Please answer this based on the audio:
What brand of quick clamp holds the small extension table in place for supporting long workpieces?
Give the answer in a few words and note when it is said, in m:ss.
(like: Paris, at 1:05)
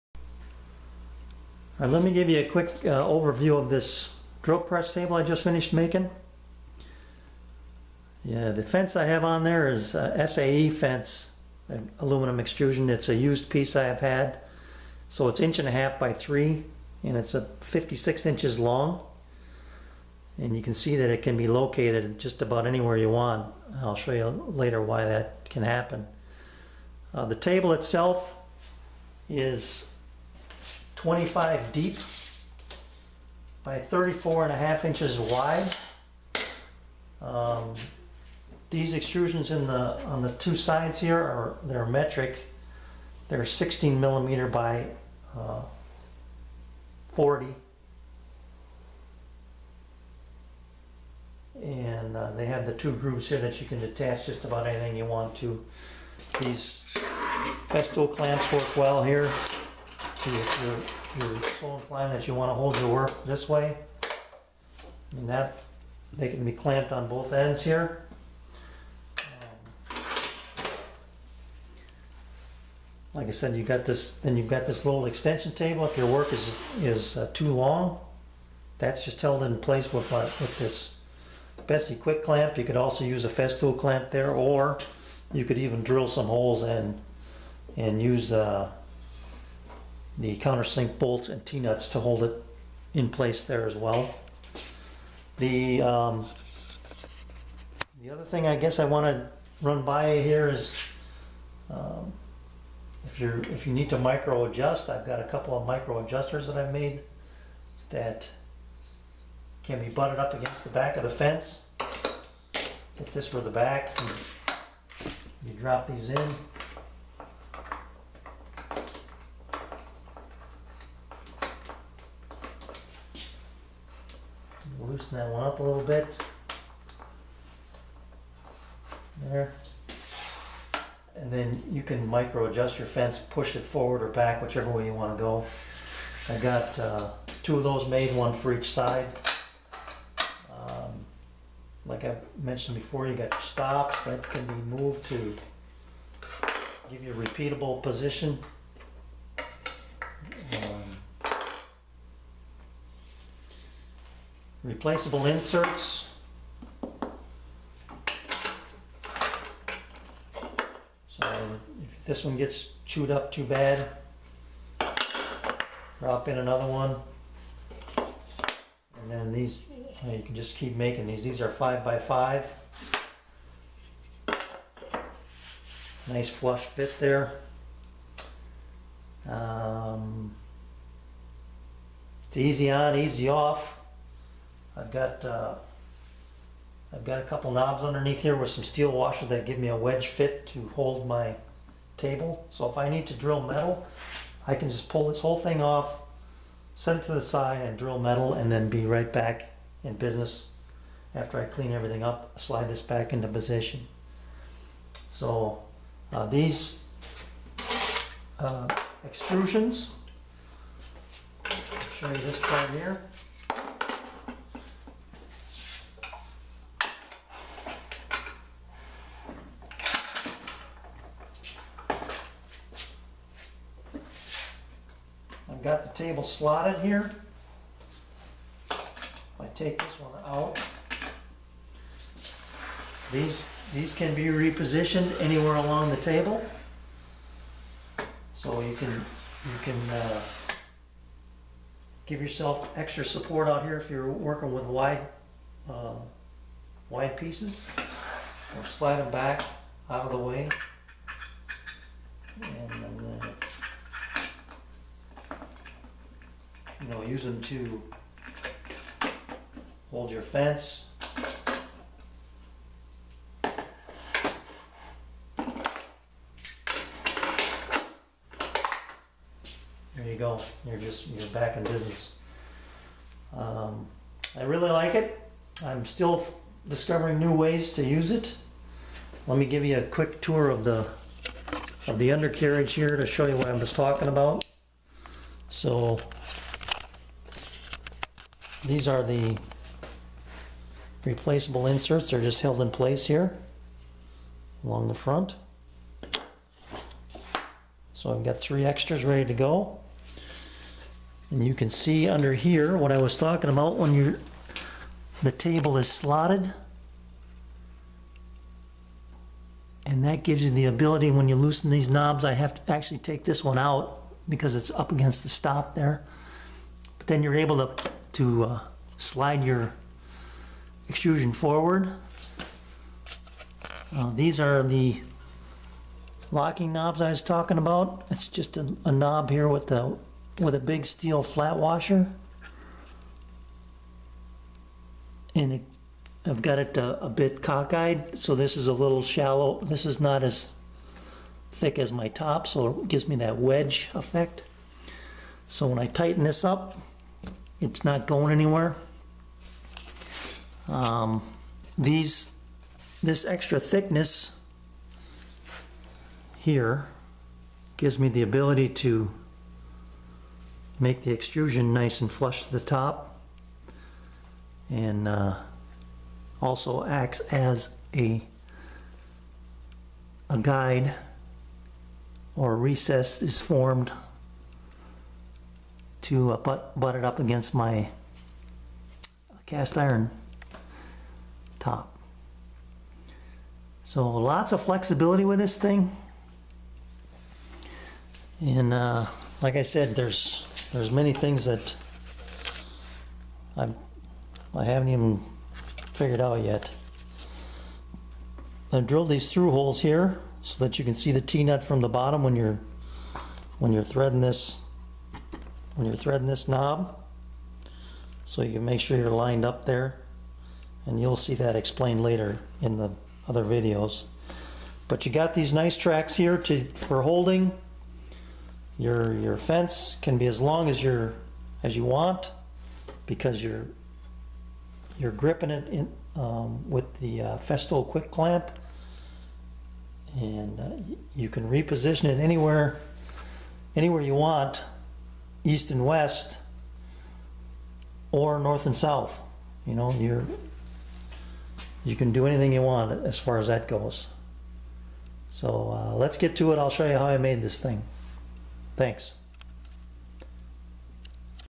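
Bessey, at 1:21.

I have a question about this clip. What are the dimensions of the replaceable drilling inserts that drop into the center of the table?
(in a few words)
5 by 5.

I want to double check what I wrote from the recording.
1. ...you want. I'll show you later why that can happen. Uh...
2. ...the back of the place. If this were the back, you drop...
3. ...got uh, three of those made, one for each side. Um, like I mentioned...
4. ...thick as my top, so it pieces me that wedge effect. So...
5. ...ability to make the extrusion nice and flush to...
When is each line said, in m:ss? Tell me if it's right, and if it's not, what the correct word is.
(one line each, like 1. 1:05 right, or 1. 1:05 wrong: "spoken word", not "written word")
1. 0:22 right
2. 1:50 wrong: "fence", not "place"
3. 2:16 wrong: "two", not "three"
4. 5:41 wrong: "gives", not "pieces"
5. 5:58 right.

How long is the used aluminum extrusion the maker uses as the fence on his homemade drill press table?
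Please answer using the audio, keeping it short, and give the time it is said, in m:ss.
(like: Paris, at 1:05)
56 inches, at 0:17.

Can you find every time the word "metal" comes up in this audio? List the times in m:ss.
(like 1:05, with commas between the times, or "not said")
3:13, 3:17.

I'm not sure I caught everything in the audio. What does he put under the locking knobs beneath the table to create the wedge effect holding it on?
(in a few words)
Steel flat washer.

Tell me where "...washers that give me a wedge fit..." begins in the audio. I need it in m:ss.
3:08.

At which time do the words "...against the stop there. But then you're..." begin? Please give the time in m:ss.
5:14.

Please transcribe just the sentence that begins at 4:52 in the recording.
They're just held in place here along the front.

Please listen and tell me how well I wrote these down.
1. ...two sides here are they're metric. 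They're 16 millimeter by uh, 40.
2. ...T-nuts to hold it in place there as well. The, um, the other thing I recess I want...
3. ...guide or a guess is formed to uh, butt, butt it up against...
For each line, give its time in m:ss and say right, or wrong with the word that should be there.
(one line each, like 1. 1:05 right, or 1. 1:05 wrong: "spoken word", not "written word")
1. 0:40 right
2. 1:31 wrong: "guess", not "recess"
3. 6:10 wrong: "recess", not "guess".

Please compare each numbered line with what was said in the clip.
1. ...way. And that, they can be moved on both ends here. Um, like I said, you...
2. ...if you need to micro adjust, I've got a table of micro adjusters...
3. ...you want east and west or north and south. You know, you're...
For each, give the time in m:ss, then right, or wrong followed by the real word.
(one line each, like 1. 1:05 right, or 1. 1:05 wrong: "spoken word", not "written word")
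1. 1:03 wrong: "clamped", not "moved"
2. 1:43 wrong: "couple", not "table"
3. 7:14 right.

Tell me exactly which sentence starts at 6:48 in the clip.
So you make sure you're lined up there.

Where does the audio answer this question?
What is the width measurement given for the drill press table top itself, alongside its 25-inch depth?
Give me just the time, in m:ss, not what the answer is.
0:33.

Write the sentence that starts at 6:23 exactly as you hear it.
So lots of flexibility with this thing.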